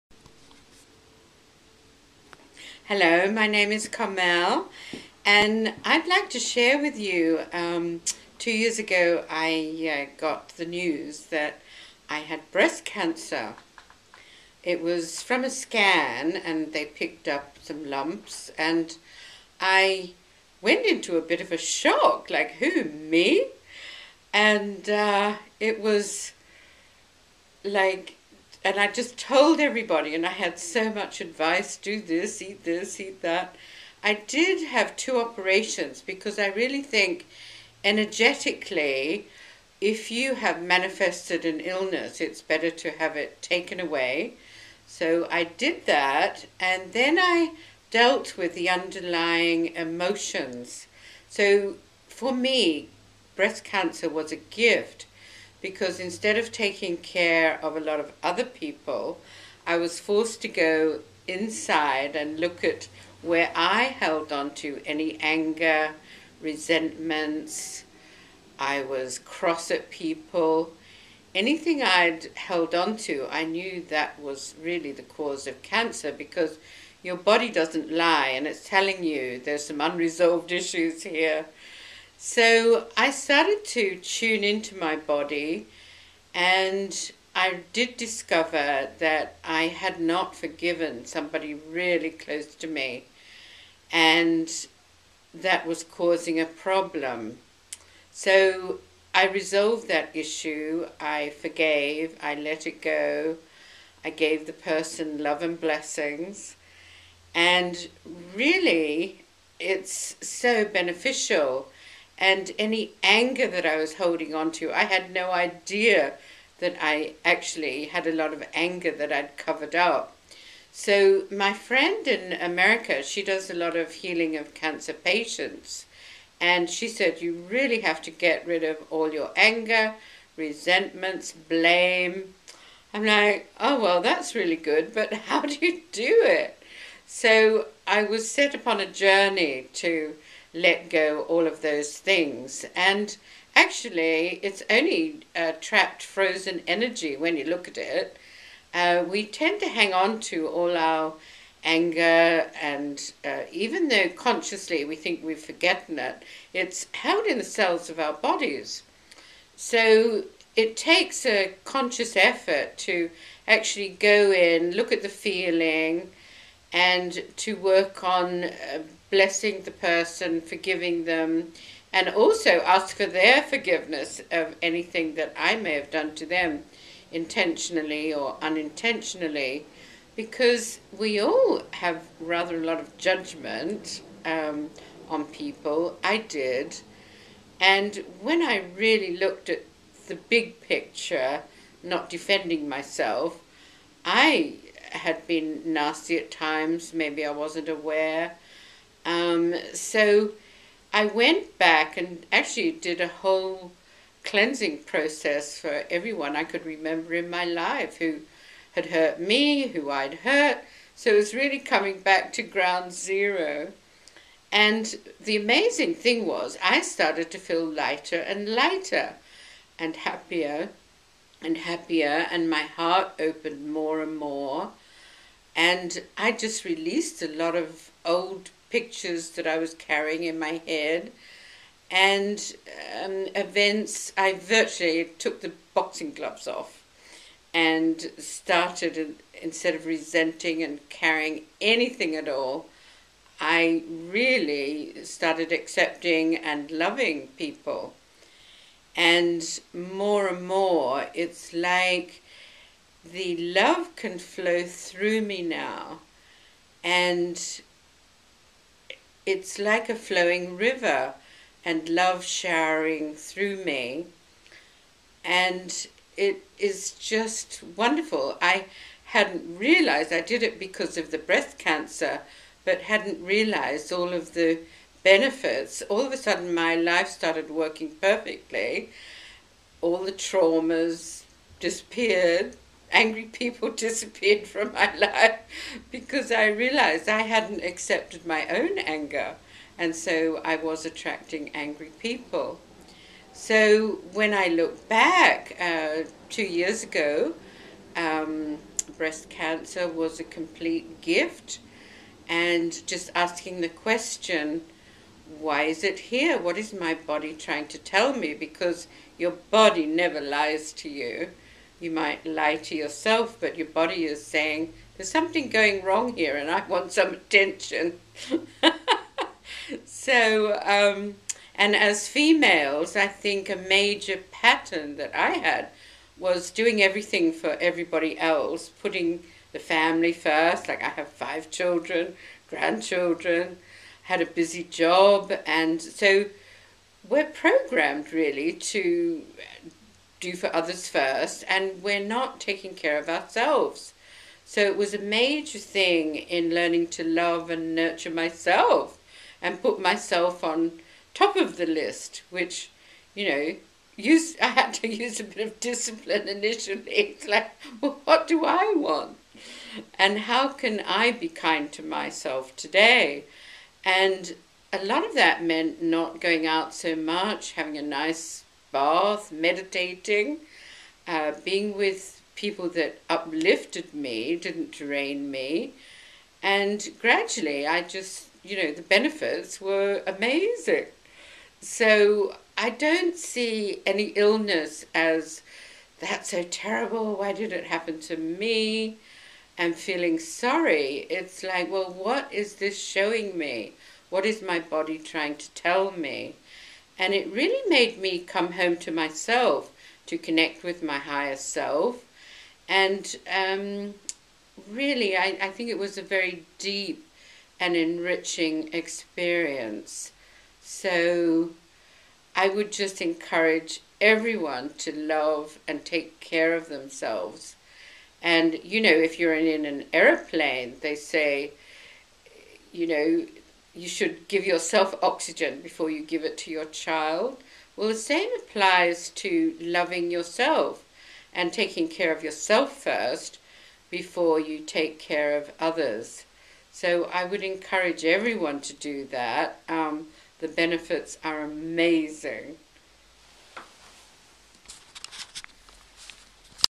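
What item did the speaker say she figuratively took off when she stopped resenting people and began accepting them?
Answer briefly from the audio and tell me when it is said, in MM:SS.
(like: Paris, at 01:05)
Boxing gloves, at 03:55.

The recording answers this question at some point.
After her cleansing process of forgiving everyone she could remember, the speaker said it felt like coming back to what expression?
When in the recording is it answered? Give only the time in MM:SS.
03:32.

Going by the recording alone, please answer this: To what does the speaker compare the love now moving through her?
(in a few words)
A flowing river.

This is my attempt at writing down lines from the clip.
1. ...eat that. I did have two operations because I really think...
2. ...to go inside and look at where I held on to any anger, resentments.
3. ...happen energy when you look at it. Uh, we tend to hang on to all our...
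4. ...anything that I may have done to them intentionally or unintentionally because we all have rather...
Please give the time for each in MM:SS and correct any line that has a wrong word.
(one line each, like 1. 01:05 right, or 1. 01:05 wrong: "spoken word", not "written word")
1. 00:32 right
2. 01:00 right
3. 02:26 wrong: "frozen", not "happen"
4. 02:54 right.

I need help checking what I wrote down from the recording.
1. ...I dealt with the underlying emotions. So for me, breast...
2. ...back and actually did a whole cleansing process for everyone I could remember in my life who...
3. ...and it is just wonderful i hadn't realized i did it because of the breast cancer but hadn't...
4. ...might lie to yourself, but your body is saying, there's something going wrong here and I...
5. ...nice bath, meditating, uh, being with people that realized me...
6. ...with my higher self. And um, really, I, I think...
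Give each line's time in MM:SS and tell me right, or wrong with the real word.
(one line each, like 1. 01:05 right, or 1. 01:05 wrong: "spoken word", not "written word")
1. 00:47 right
2. 03:21 right
3. 04:25 right
4. 05:11 right
5. 06:07 wrong: "uplifted", not "realized"
6. 06:40 right.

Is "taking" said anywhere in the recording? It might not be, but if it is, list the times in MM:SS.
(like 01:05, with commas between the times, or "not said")
00:56, 05:42, 07:11.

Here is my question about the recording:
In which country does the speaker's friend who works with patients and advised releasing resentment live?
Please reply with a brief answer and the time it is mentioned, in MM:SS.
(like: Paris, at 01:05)
America, at 02:02.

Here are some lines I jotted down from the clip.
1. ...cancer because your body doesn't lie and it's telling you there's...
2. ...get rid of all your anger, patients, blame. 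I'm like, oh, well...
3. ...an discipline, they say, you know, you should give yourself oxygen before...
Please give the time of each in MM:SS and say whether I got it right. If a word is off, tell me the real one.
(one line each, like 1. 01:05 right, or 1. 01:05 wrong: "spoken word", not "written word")
1. 01:15 right
2. 02:08 wrong: "resentments", not "patients"
3. 06:59 wrong: "aeroplane", not "discipline".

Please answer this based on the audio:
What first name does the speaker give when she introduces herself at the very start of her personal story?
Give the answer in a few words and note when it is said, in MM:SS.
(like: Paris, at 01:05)
Carmel, at 00:03.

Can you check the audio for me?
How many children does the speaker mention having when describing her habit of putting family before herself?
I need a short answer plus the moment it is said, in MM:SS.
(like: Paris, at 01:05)
5, at 05:31.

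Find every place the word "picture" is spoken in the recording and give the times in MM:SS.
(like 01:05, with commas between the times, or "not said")
03:10, 03:48.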